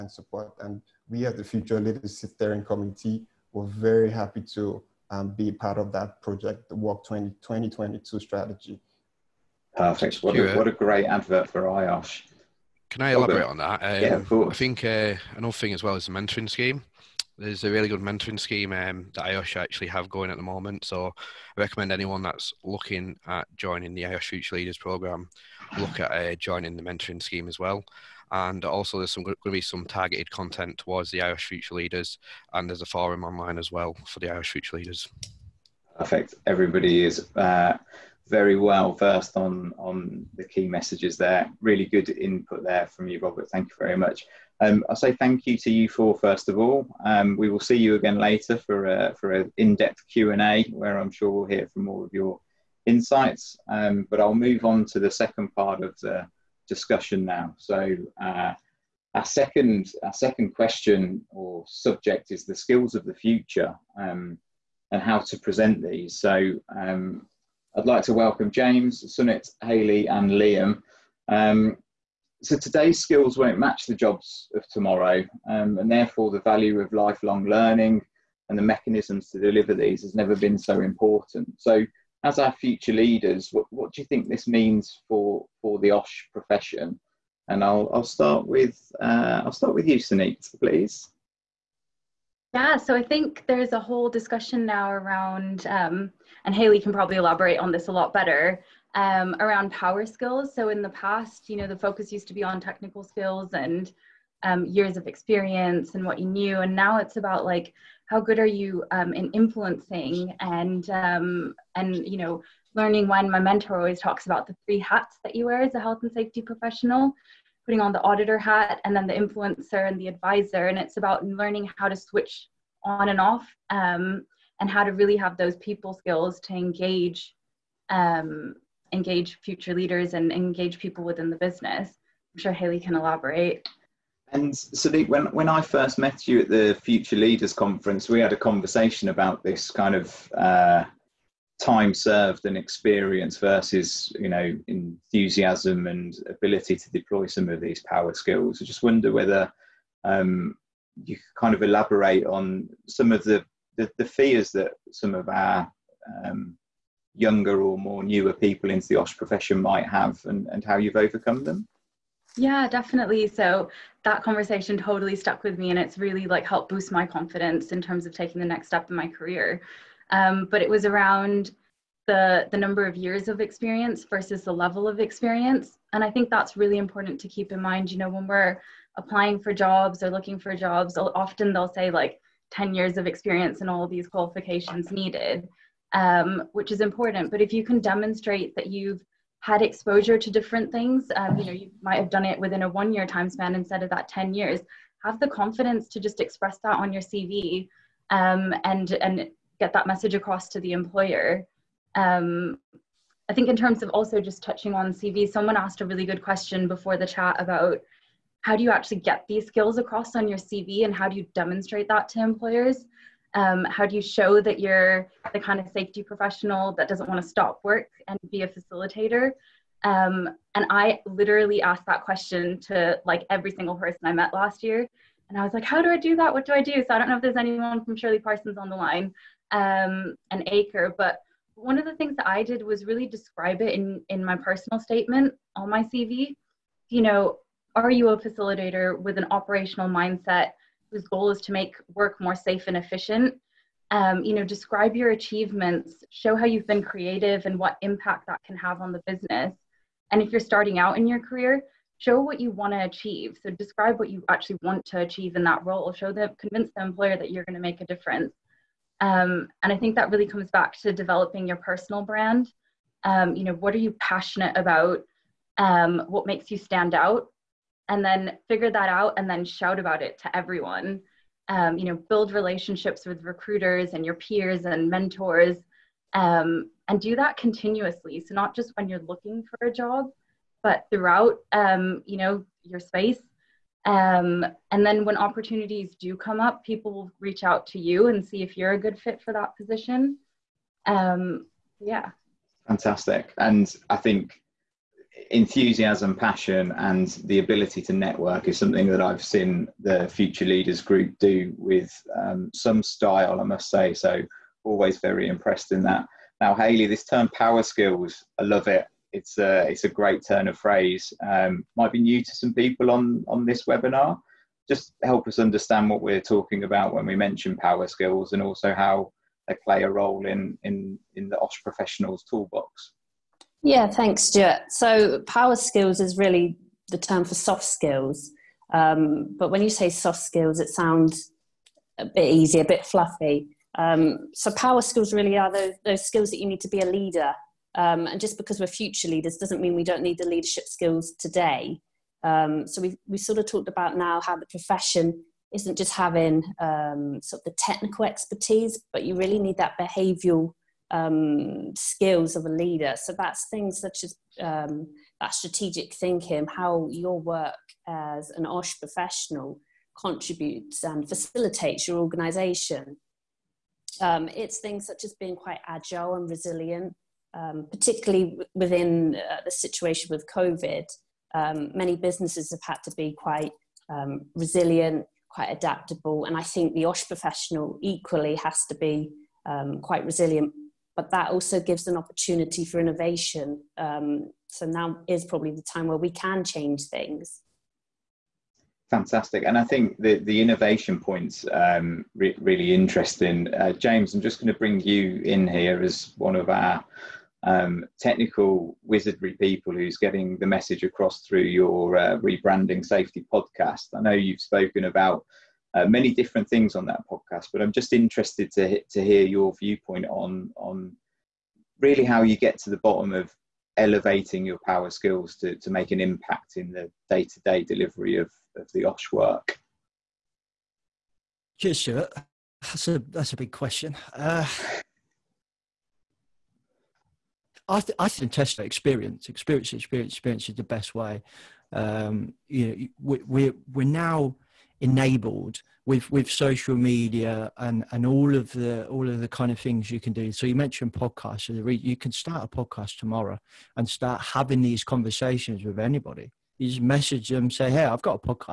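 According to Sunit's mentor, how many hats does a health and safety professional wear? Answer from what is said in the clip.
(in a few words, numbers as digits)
3.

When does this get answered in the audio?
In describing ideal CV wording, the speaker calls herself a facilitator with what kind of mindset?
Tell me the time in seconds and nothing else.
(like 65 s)
239 s.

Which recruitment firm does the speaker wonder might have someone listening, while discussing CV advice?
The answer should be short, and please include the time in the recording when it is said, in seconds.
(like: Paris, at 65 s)
Shirley Parsons, at 227 s.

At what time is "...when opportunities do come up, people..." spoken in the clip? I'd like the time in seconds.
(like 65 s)
285 s.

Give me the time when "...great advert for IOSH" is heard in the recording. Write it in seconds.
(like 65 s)
10 s.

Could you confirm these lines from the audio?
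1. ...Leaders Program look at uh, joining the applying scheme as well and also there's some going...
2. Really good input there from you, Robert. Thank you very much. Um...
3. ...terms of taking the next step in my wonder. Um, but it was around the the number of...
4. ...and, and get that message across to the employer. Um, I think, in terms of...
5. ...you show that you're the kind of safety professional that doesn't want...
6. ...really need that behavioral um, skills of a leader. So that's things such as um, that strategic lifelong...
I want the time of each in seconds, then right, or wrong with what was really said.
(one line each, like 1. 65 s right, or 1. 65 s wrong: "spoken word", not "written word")
1. 24 s wrong: "mentoring", not "applying"
2. 41 s right
3. 167 s wrong: "career", not "wonder"
4. 198 s right
5. 213 s right
6. 349 s wrong: "thinking", not "lifelong".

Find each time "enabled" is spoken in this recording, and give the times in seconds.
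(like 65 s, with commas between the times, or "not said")
434 s.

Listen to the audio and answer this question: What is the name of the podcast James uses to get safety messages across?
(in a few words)
Rebranding Safety.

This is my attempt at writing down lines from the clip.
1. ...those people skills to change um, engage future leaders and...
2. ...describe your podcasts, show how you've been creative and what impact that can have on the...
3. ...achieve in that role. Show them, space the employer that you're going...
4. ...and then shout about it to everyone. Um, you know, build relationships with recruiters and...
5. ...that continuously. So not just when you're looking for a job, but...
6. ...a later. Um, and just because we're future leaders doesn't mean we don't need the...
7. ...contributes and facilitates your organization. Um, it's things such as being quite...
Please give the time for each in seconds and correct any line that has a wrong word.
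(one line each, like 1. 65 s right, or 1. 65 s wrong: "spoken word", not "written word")
1. 125 s wrong: "engage", not "change"
2. 244 s wrong: "achievements", not "podcasts"
3. 254 s wrong: "convince", not "space"
4. 269 s right
5. 277 s right
6. 336 s wrong: "leader", not "later"
7. 359 s right.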